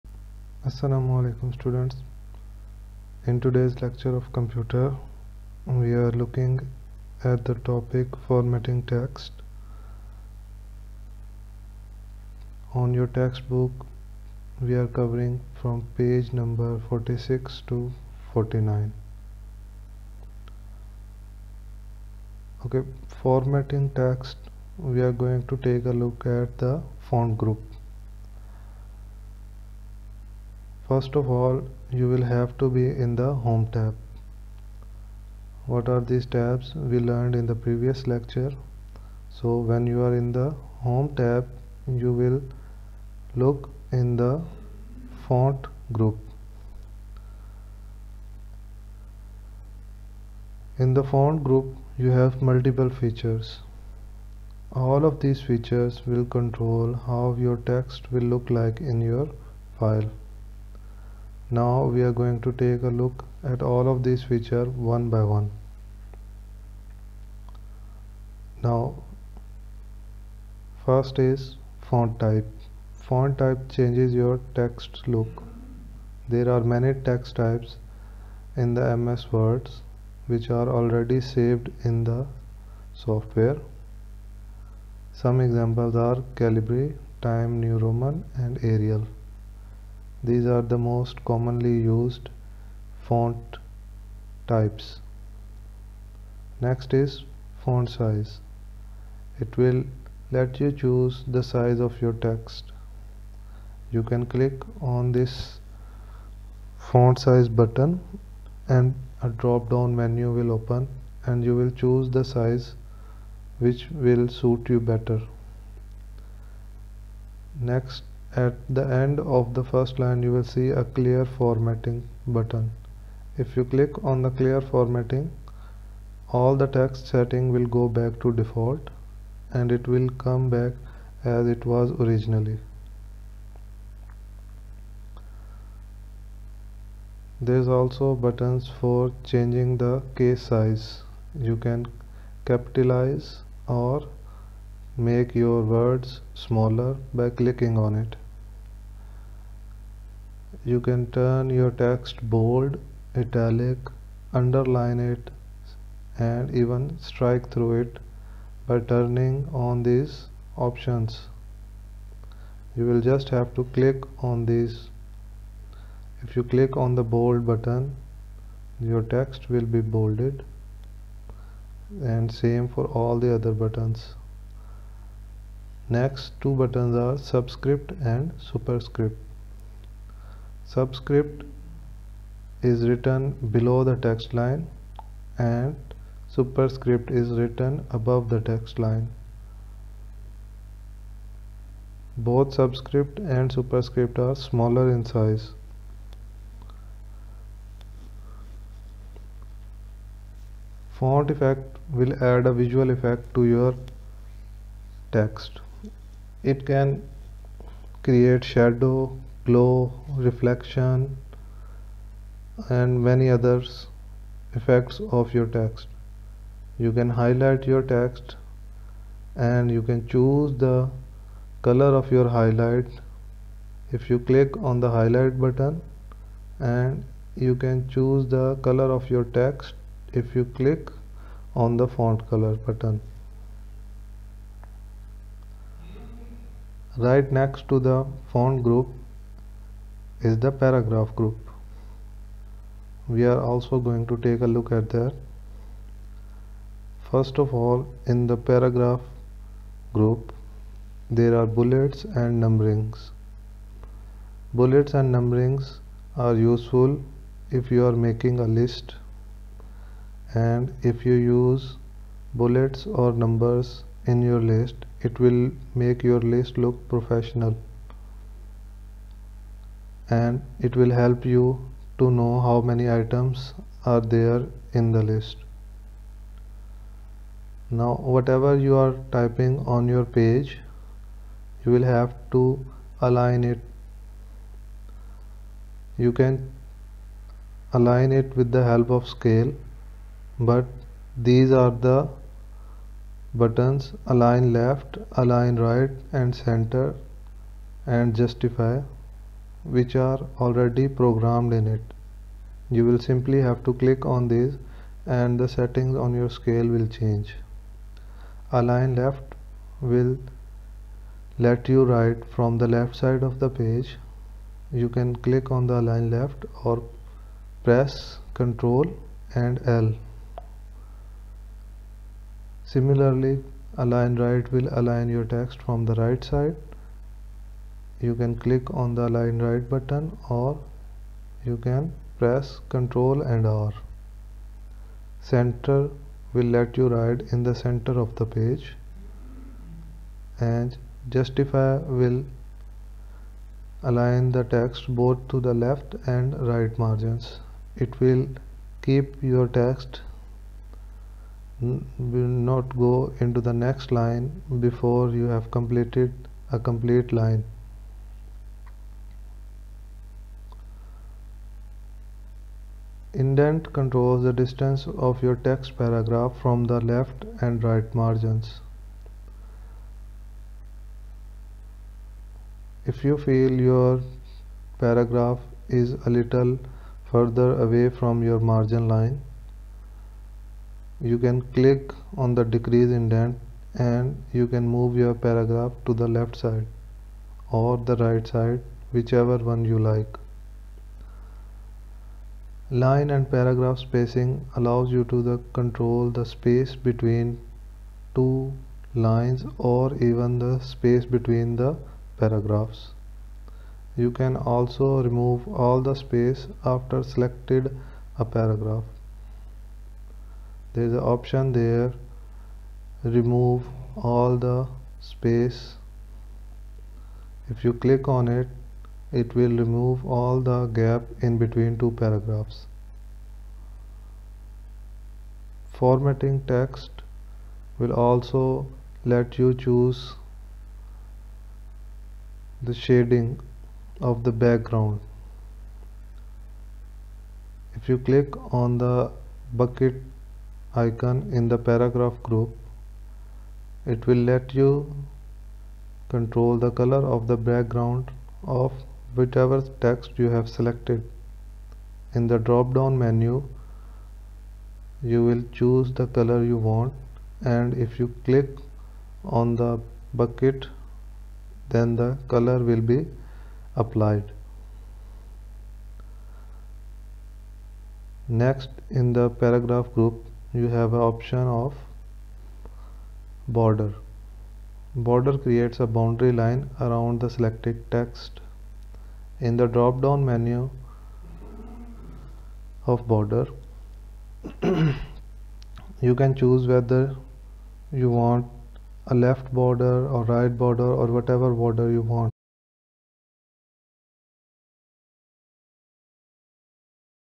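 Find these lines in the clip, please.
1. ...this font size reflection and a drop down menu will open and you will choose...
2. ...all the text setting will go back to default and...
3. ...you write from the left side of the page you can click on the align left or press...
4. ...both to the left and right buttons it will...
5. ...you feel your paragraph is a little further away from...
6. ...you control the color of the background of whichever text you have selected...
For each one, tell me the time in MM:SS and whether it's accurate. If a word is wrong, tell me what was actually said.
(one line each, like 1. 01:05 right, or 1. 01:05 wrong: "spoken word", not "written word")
1. 01:45 wrong: "button", not "reflection"
2. 02:06 right
3. 05:11 right
4. 05:45 wrong: "margins", not "buttons"
5. 06:13 right
6. 07:24 right.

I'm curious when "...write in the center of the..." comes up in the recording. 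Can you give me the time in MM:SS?
05:36.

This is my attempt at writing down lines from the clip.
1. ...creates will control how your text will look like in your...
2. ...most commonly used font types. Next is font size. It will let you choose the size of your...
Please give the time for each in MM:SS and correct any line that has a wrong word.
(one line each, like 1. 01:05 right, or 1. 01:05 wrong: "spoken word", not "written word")
1. 00:55 wrong: "features", not "creates"
2. 01:30 right.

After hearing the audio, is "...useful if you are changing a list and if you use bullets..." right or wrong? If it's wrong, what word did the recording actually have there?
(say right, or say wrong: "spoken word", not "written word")
wrong: "making", not "changing".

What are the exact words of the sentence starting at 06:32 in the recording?
Line and paragraph spacing allows you to the control the space between two lines or even the space between the paragraphs.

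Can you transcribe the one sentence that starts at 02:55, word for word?
Next two buttons are subscript and superscript.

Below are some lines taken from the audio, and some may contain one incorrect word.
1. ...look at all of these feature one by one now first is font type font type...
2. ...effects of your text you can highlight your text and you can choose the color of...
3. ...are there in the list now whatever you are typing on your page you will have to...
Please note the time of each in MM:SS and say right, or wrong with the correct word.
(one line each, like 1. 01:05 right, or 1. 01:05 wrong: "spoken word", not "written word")
1. 01:02 right
2. 03:34 right
3. 04:33 right.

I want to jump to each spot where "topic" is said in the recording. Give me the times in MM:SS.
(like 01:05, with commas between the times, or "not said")
00:07.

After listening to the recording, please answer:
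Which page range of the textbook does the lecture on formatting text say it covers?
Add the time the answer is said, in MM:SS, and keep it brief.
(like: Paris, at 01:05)
46 to 49, at 00:16.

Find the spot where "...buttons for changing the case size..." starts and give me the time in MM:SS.
02:18.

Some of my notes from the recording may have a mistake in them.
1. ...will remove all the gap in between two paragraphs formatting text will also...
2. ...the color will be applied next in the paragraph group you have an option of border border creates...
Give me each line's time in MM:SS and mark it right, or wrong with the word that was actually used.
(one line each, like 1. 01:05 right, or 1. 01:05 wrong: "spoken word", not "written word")
1. 06:59 right
2. 07:41 right.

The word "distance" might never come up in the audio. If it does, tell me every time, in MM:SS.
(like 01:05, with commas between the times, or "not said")
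06:04.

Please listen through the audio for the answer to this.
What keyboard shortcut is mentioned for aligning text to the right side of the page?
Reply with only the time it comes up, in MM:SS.
05:32.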